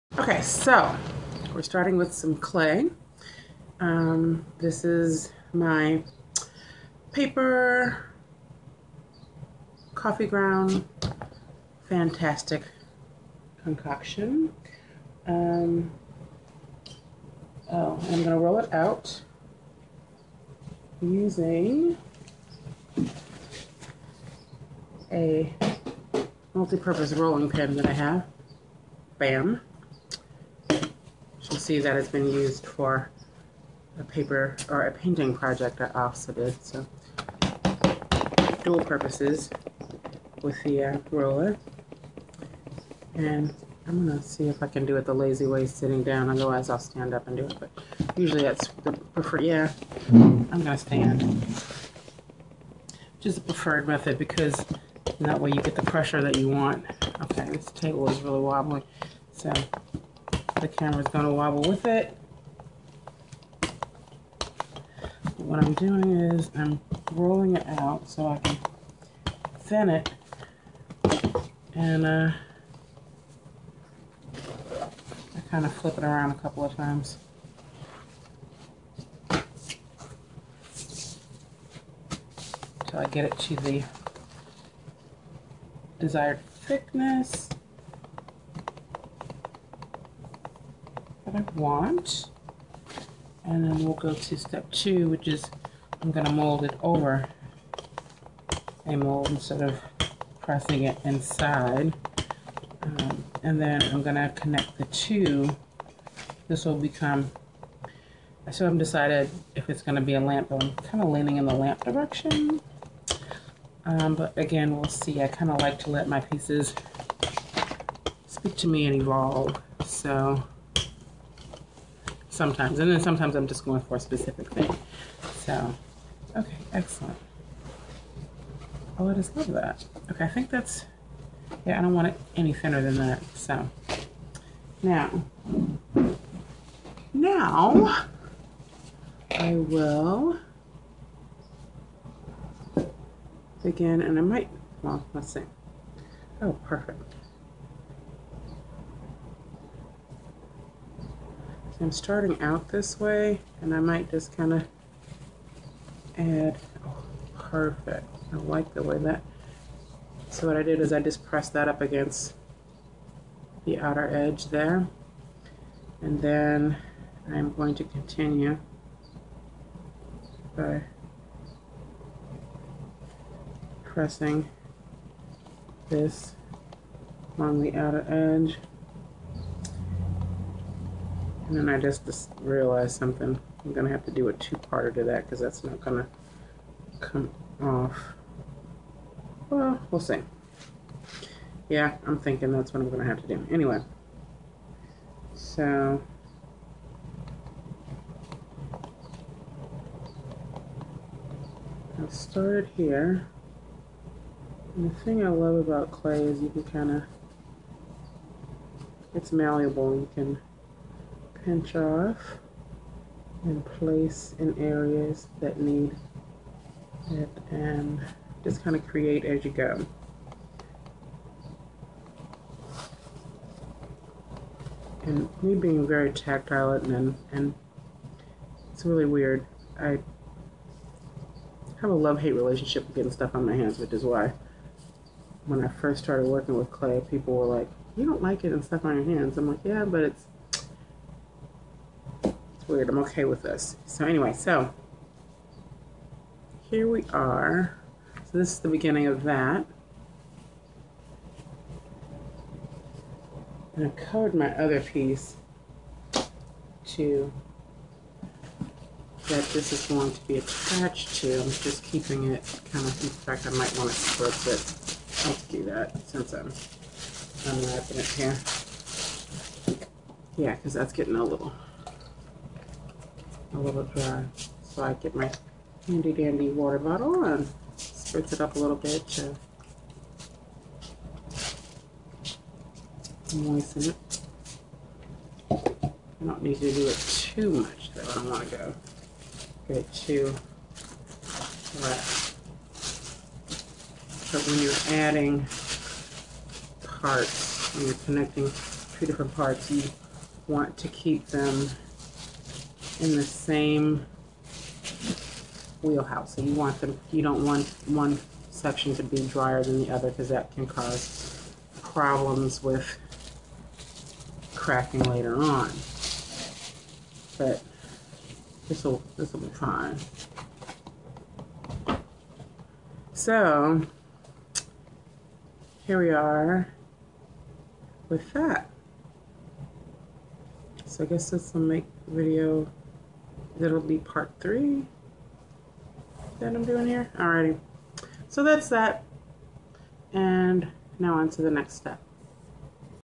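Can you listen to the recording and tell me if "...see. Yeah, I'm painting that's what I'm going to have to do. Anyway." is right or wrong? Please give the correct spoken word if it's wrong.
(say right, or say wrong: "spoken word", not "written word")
wrong: "thinking", not "painting".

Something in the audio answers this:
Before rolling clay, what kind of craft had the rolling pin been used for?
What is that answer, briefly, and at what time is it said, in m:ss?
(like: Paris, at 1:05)
Painting, at 0:34.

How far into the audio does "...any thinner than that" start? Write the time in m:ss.
2:12.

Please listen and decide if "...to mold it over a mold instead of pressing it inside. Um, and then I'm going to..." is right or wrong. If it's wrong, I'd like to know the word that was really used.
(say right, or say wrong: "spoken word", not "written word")
right.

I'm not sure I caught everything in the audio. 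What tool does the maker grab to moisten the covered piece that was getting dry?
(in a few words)
Water bottle.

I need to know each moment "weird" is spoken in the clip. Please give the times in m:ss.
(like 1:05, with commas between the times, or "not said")
3:49, 4:02.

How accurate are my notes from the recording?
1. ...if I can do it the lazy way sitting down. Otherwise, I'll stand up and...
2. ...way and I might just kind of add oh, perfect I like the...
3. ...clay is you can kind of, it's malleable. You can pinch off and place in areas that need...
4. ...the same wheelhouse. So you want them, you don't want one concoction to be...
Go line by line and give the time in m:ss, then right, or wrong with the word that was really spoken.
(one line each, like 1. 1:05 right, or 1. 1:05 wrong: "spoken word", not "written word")
1. 0:44 right
2. 2:32 right
3. 3:25 right
4. 5:03 wrong: "section", not "concoction".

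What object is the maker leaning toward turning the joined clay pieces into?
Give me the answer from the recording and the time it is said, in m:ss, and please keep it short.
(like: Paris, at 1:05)
A lamp, at 1:50.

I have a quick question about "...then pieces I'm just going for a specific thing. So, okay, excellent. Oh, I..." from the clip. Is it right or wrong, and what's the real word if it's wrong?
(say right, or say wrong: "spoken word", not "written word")
wrong: "sometimes", not "pieces".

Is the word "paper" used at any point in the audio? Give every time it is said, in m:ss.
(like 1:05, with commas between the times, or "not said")
0:07, 0:34.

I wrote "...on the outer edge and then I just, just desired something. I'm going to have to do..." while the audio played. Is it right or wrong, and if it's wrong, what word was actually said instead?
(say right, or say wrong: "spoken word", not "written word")
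wrong: "realized", not "desired".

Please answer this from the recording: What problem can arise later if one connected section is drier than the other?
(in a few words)
Cracking.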